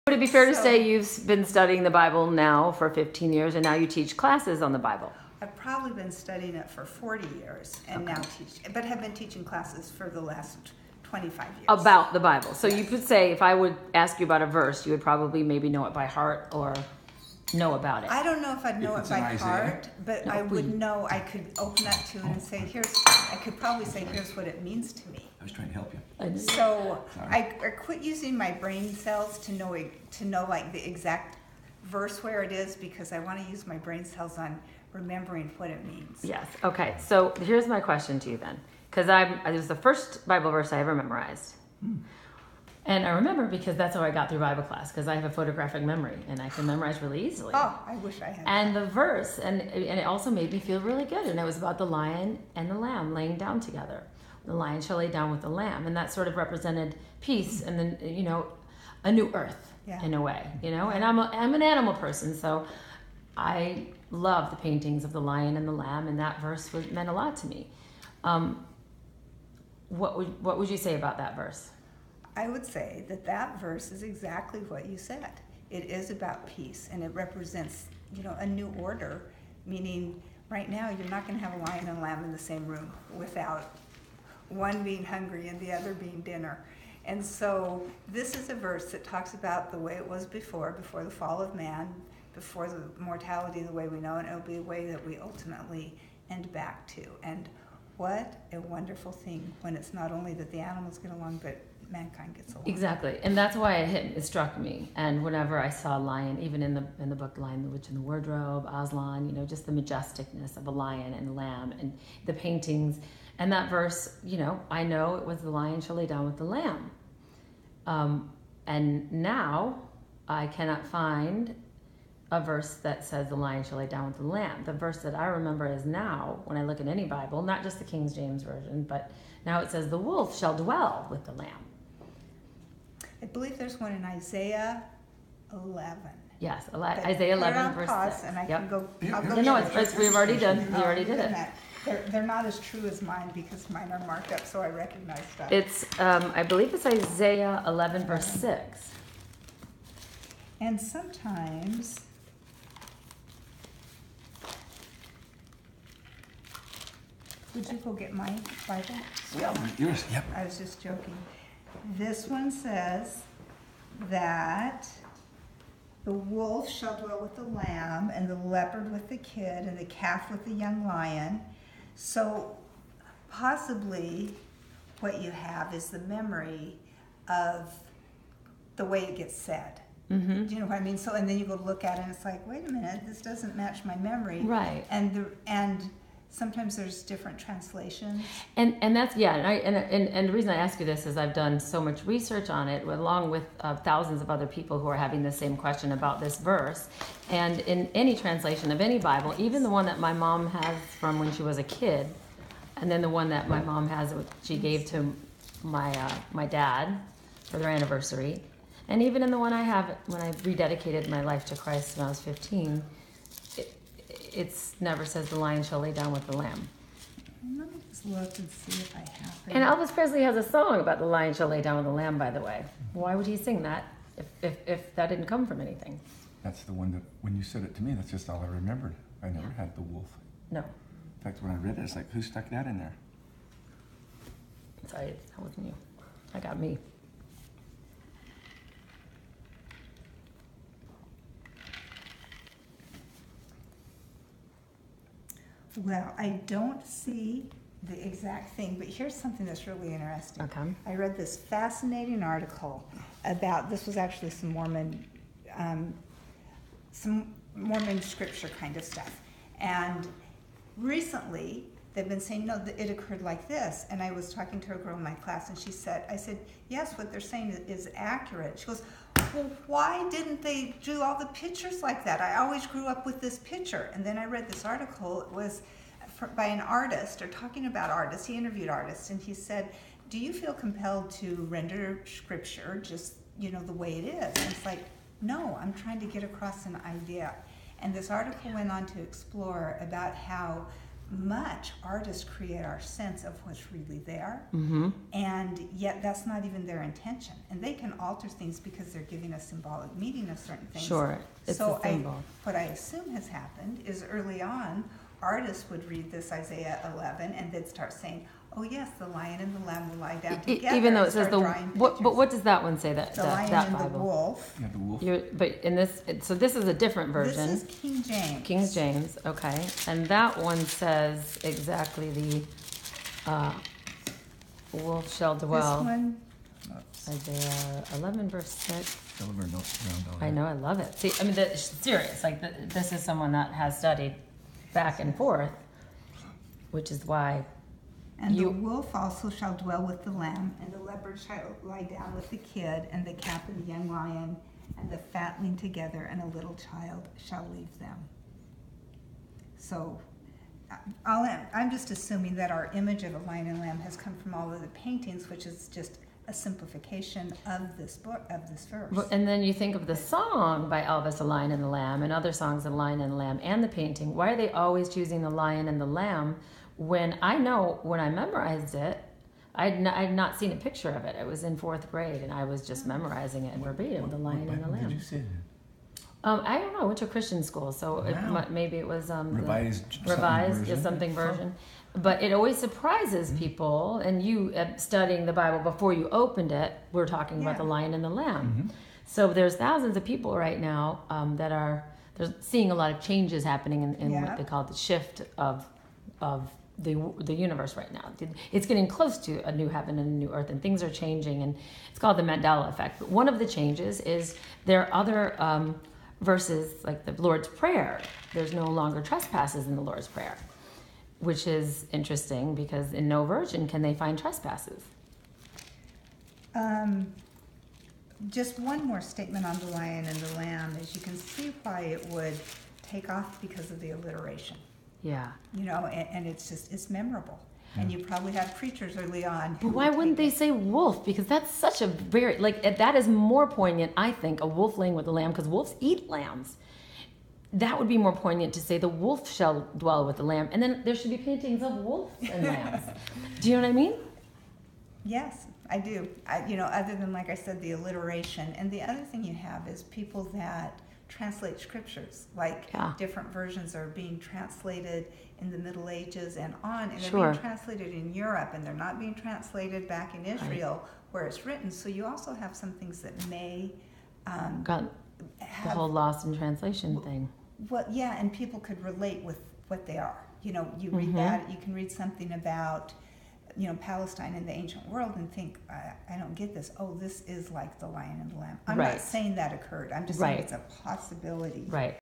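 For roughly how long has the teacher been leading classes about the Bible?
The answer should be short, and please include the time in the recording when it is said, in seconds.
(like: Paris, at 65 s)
25 years, at 11 s.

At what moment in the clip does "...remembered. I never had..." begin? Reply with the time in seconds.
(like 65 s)
228 s.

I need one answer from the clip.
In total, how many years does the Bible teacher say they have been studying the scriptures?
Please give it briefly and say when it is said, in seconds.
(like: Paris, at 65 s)
40 years, at 6 s.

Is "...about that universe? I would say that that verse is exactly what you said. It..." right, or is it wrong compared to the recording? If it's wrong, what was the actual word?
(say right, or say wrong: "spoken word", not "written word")
wrong: "verse", not "universe".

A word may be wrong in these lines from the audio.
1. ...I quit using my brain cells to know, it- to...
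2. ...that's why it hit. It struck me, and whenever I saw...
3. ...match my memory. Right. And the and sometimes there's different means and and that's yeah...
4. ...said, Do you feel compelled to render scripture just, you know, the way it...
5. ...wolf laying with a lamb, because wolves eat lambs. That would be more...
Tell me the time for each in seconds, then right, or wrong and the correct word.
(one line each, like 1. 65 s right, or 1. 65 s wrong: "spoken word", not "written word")
1. 27 s right
2. 103 s right
3. 183 s wrong: "translations", not "means"
4. 279 s right
5. 434 s right.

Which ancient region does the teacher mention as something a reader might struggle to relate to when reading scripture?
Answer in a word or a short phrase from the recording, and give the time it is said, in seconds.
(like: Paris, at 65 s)
Palestine, at 473 s.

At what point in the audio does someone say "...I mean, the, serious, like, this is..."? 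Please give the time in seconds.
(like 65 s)
331 s.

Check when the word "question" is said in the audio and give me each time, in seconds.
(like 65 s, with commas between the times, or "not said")
37 s, 195 s.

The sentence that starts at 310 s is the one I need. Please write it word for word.
Even though it says the, what, but what does that one say, that, The that, lion that and the Bible?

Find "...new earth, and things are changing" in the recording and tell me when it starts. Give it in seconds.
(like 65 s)
400 s.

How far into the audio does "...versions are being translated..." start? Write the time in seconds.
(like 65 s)
453 s.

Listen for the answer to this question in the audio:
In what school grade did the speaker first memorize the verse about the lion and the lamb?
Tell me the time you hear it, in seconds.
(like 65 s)
371 s.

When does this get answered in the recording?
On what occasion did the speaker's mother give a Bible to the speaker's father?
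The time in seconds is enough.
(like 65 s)
207 s.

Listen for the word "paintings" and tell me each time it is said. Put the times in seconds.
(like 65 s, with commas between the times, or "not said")
64 s, 112 s, 354 s, 363 s, 441 s.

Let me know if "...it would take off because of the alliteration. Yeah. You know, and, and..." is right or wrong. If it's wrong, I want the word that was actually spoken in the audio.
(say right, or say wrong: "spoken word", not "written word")
right.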